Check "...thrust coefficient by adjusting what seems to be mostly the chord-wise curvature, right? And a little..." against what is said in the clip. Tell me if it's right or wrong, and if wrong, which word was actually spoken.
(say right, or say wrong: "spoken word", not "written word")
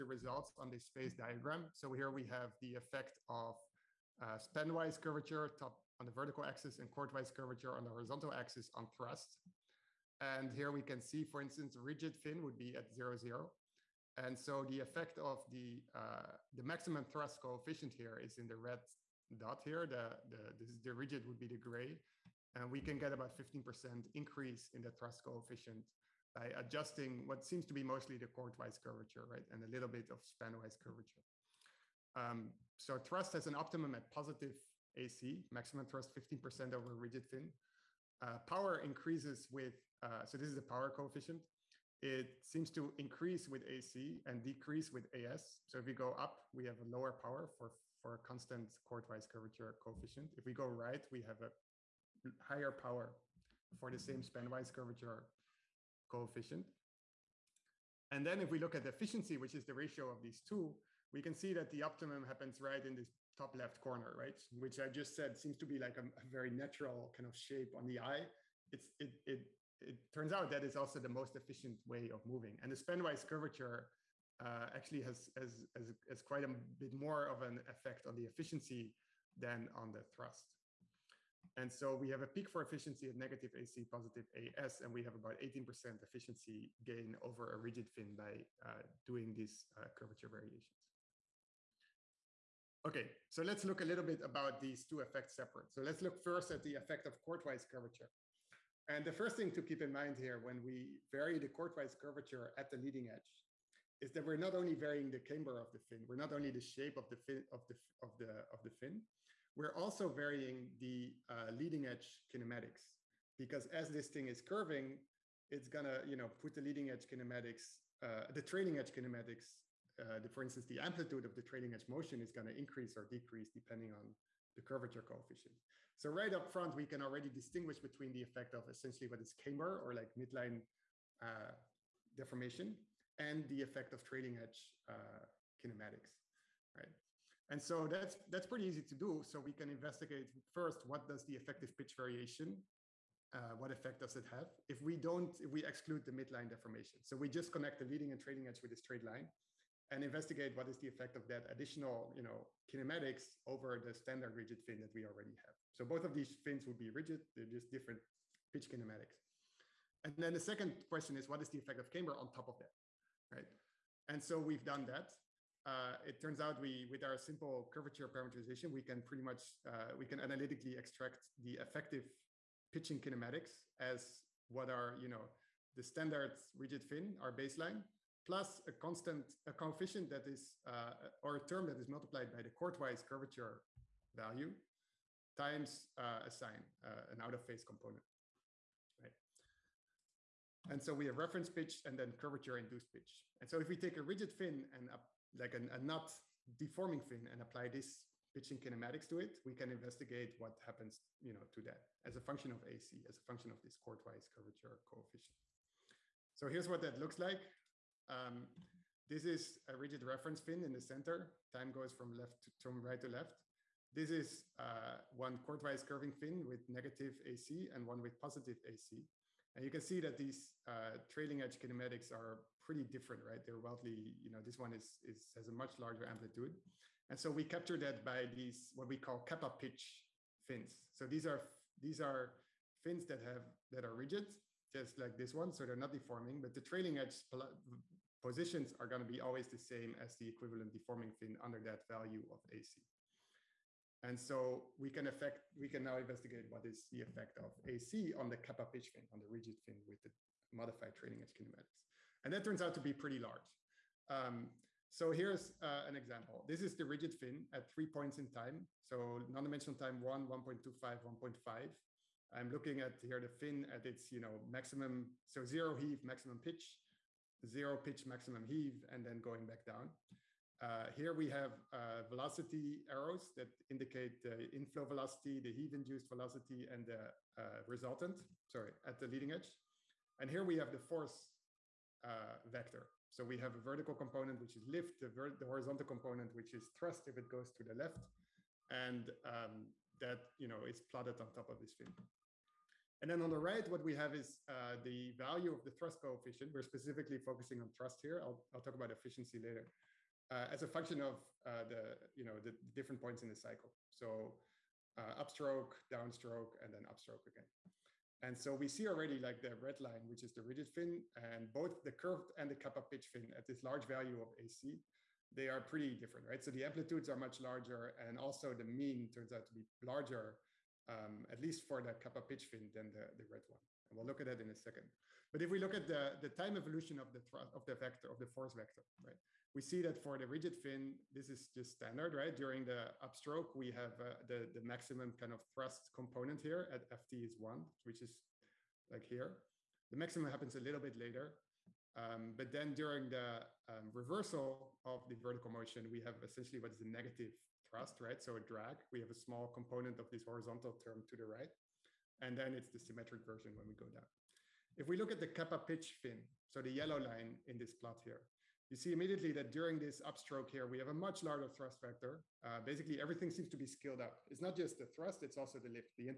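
right.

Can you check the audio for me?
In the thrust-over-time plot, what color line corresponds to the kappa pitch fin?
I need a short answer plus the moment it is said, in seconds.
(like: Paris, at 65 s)
yellow, at 356 s.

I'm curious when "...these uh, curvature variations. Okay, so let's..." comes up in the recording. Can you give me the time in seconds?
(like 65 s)
89 s.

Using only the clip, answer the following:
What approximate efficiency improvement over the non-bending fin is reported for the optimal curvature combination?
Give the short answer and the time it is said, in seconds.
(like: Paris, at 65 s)
18%, at 85 s.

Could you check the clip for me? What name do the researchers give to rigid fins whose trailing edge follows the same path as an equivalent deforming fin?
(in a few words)
kappa pitch fins.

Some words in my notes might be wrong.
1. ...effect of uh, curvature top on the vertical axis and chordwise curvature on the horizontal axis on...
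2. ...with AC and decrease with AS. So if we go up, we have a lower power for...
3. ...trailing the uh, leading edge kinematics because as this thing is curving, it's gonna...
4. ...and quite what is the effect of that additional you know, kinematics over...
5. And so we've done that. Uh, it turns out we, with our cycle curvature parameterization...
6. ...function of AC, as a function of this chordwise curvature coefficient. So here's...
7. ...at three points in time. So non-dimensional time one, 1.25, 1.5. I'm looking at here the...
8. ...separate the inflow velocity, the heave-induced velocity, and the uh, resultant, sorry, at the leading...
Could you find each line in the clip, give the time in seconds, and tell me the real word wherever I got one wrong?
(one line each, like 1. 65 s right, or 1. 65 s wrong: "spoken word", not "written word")
1. 2 s right
2. 43 s right
3. 110 s wrong: "varying", not "trailing"
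4. 149 s wrong: "investigate", not "quite"
5. 164 s wrong: "simple", not "cycle"
6. 202 s right
7. 257 s right
8. 273 s wrong: "indicate", not "separate".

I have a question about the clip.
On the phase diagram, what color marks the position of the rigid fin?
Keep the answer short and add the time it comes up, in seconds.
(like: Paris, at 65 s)
gray, at 21 s.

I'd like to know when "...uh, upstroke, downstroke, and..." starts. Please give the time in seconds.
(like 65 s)
304 s.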